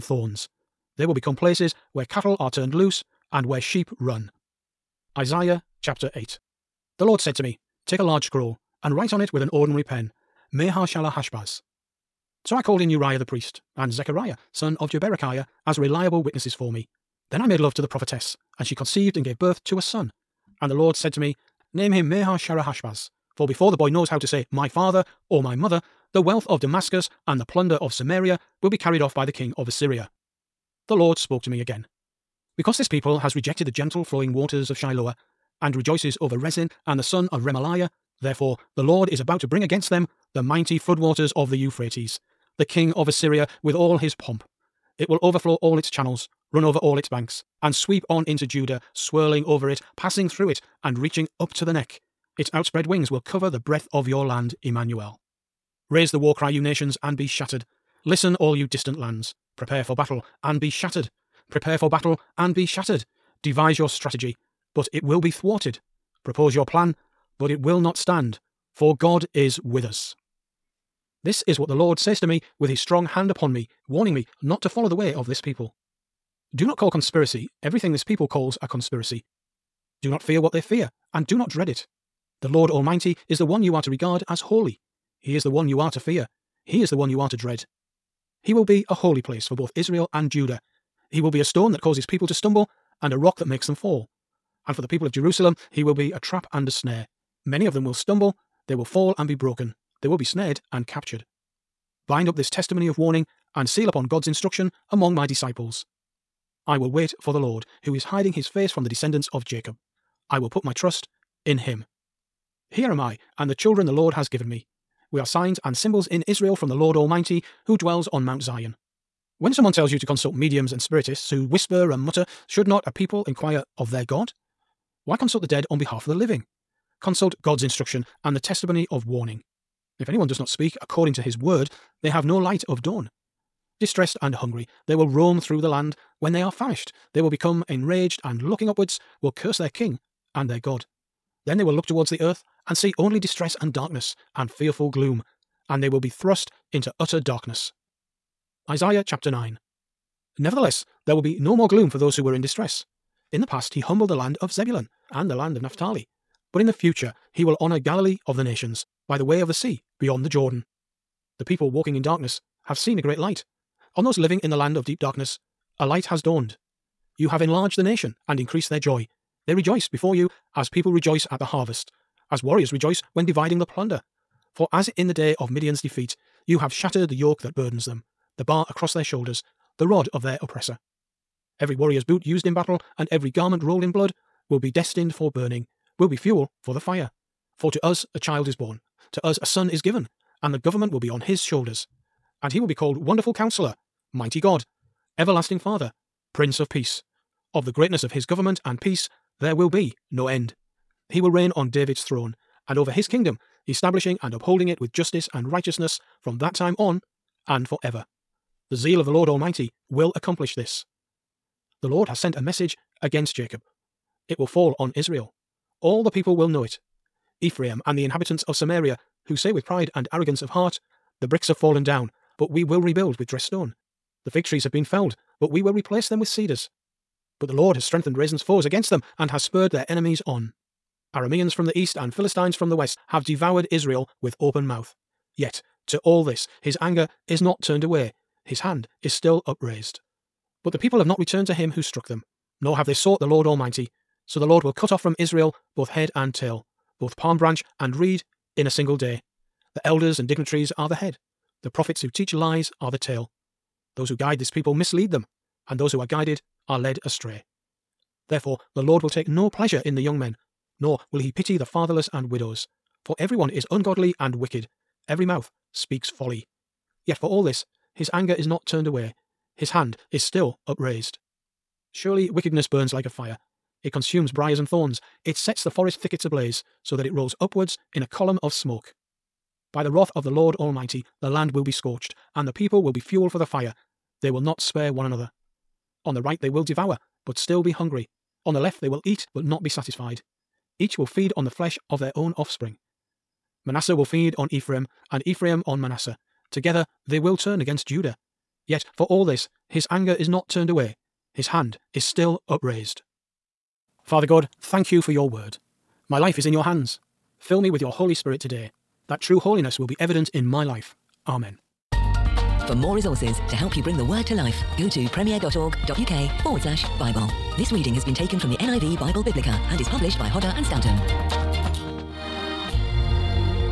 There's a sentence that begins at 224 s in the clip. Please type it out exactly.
The fig trees have been felled, but we will replace them with cedars.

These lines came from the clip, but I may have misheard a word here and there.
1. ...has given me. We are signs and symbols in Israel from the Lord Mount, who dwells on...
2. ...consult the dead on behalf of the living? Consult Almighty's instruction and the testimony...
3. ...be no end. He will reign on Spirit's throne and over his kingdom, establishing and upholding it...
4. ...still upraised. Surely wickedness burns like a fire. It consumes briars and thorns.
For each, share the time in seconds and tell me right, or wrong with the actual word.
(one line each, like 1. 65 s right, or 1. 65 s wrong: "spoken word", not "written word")
1. 114 s wrong: "Almighty", not "Mount"
2. 125 s wrong: "God", not "Almighty"
3. 199 s wrong: "David", not "Spirit"
4. 270 s right.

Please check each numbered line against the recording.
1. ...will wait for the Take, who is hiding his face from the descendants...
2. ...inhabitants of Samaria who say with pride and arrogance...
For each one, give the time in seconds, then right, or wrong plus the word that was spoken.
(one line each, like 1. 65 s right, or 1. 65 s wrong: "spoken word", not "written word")
1. 106 s wrong: "Lord", not "Take"
2. 218 s right.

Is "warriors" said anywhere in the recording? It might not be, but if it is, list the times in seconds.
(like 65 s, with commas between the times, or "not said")
172 s, 181 s.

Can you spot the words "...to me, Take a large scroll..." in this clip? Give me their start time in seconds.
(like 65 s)
7 s.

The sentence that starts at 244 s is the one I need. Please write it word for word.
So the Lord will cut off from Israel both head and tail, both palm branch and reed in a single day.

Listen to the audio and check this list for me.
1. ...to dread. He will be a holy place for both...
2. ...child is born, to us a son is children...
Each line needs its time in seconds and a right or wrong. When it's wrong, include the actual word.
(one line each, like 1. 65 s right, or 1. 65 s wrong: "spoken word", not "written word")
1. 87 s right
2. 188 s wrong: "given", not "children".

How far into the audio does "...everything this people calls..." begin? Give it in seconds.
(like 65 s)
77 s.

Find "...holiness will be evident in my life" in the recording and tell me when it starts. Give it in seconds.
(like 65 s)
309 s.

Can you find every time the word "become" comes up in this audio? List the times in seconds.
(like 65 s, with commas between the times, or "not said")
1 s, 137 s.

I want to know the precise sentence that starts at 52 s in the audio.
Its outspread wings will cover the breadth of your land, Emmanuel.